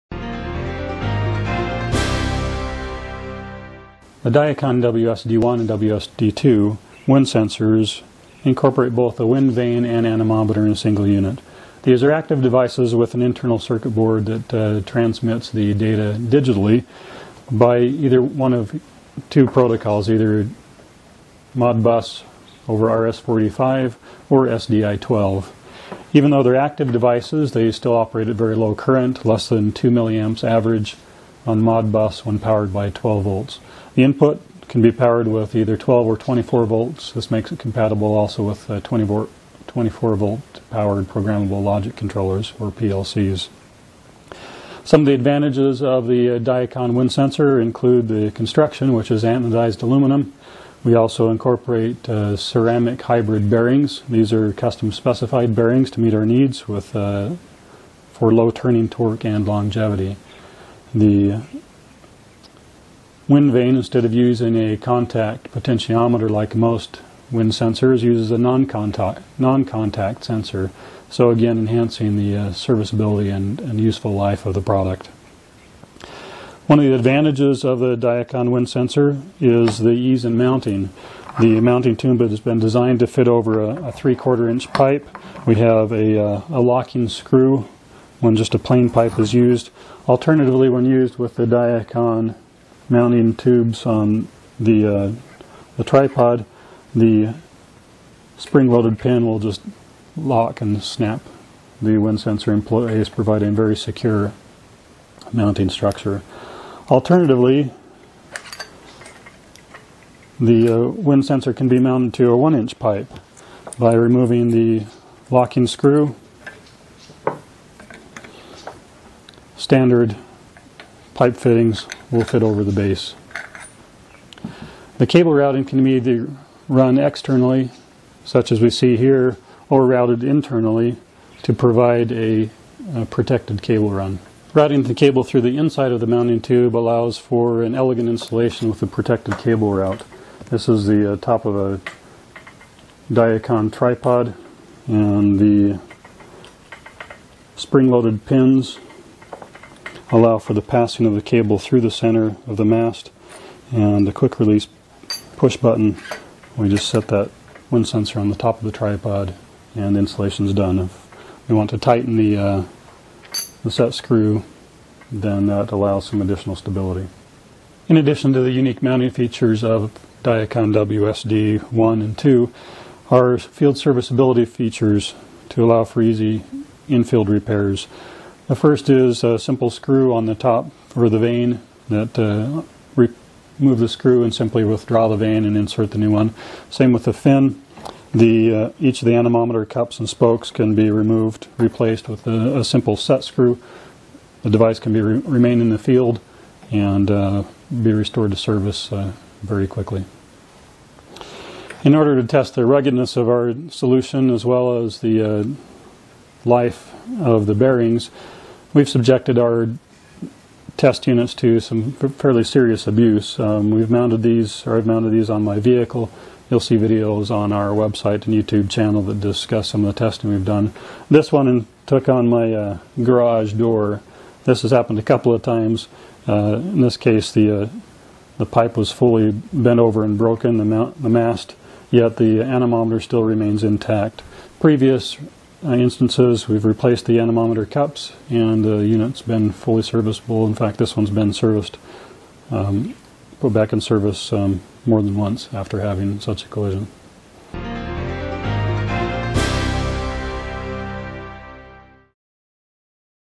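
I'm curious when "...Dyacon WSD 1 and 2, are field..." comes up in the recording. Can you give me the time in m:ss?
2:50.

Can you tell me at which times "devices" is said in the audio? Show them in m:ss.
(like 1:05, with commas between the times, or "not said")
0:12, 0:26, 3:14.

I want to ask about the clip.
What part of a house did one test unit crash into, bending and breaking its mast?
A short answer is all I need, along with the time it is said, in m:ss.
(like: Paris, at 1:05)
garage door, at 3:43.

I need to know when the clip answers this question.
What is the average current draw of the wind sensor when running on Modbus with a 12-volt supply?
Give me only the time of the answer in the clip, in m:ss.
0:29.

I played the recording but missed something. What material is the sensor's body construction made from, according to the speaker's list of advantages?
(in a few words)
anodized aluminum.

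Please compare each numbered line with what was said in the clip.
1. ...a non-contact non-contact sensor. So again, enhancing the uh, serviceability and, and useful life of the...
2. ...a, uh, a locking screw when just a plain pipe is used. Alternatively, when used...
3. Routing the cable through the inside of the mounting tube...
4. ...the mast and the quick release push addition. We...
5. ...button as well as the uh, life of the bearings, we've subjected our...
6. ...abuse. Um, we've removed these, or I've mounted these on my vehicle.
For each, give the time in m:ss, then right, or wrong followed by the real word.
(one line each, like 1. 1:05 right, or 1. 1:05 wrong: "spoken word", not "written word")
1. 1:08 right
2. 1:25 right
3. 2:14 right
4. 2:32 wrong: "button", not "addition"
5. 3:23 wrong: "solution", not "button"
6. 3:32 wrong: "mounted", not "removed".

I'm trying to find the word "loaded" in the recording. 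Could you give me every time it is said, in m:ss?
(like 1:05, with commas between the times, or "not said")
1:38, 2:27.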